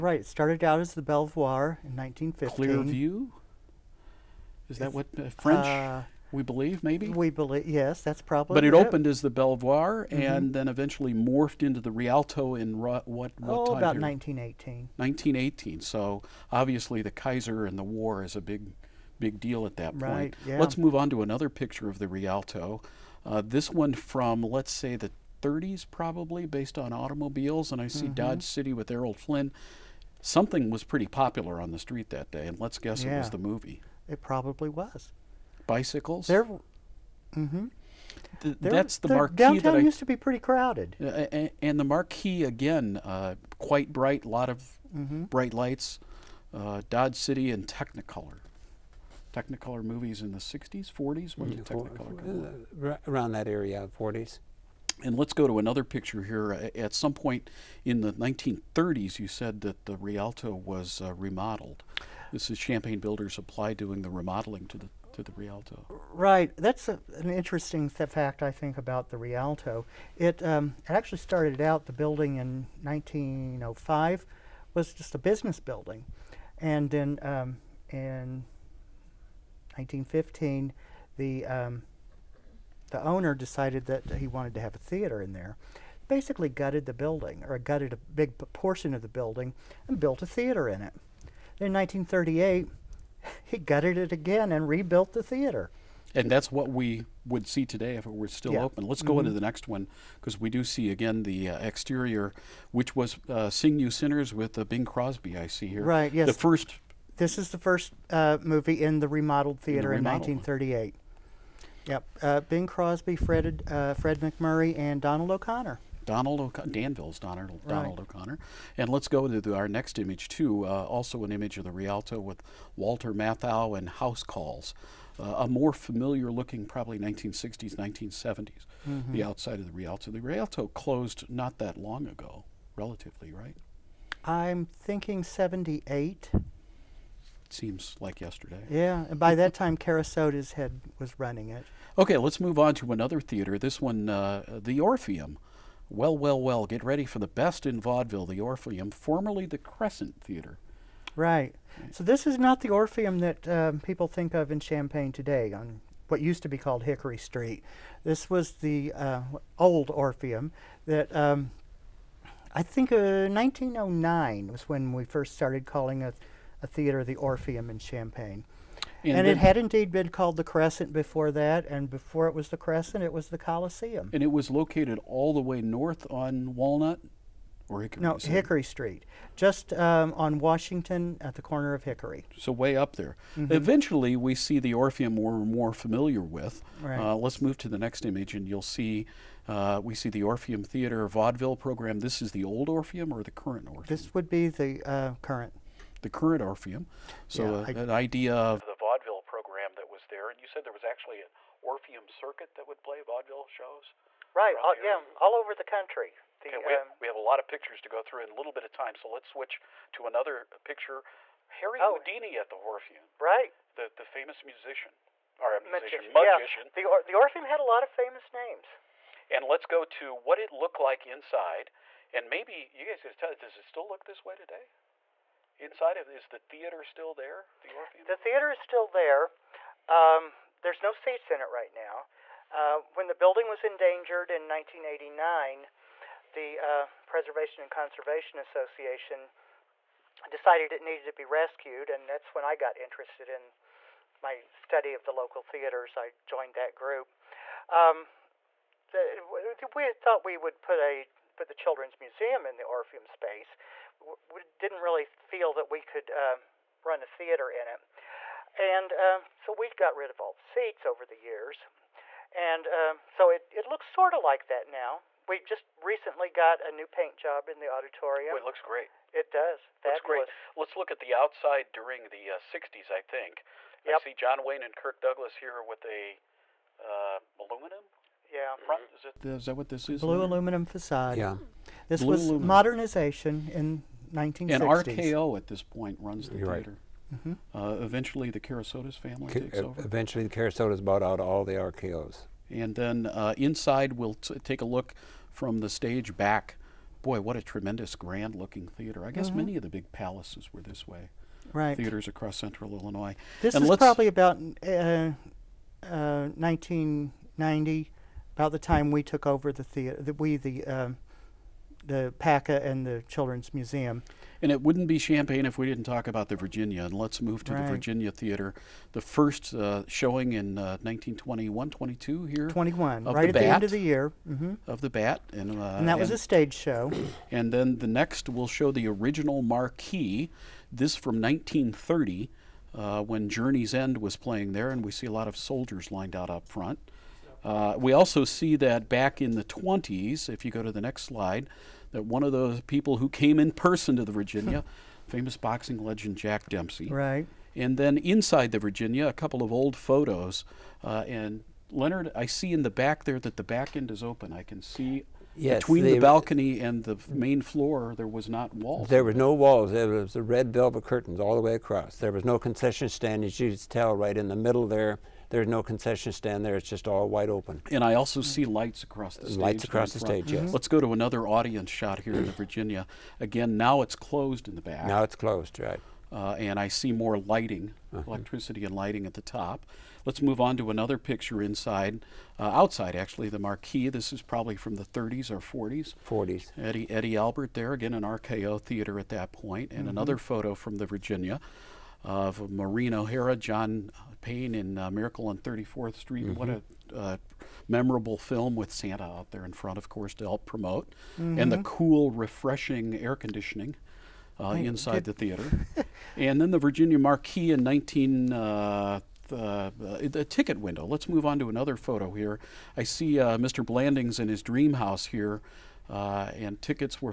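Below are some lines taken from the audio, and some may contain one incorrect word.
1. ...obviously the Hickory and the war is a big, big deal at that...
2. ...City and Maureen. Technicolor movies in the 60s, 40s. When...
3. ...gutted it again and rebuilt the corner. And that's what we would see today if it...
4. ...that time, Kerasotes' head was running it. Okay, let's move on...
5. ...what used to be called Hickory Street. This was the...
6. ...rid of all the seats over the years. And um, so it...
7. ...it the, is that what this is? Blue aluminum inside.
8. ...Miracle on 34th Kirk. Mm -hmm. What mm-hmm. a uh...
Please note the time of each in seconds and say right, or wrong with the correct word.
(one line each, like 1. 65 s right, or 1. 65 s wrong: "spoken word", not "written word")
1. 16 s wrong: "Kaiser", not "Hickory"
2. 47 s wrong: "Technicolor", not "Maureen"
3. 93 s wrong: "theater", not "corner"
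4. 139 s right
5. 156 s right
6. 259 s right
7. 279 s wrong: "facade", not "inside"
8. 394 s wrong: "Street", not "Kirk".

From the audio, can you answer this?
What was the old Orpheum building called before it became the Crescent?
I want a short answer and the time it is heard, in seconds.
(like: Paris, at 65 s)
Coliseum, at 173 s.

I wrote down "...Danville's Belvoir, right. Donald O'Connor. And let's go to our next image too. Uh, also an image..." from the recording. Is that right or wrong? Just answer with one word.
wrong.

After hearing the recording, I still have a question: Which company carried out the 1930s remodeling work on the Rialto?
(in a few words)
Champaign Builders Supply.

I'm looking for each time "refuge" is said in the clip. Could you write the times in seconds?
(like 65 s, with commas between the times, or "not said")
not said.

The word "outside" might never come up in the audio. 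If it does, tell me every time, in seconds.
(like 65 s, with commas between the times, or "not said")
129 s, 271 s, 382 s.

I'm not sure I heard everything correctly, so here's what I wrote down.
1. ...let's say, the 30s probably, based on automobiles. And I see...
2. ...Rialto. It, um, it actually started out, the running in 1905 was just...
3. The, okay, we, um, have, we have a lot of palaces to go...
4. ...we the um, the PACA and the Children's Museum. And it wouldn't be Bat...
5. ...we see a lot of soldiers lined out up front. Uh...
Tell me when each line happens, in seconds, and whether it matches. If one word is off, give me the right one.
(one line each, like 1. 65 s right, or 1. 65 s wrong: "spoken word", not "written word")
1. 24 s right
2. 69 s wrong: "building", not "running"
3. 206 s wrong: "pictures", not "palaces"
4. 310 s wrong: "Champaign", not "Bat"
5. 334 s right.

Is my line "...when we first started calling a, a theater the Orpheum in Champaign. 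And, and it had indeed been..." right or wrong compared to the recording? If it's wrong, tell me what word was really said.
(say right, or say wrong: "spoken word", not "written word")
right.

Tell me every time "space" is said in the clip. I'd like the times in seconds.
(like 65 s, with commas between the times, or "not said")
253 s.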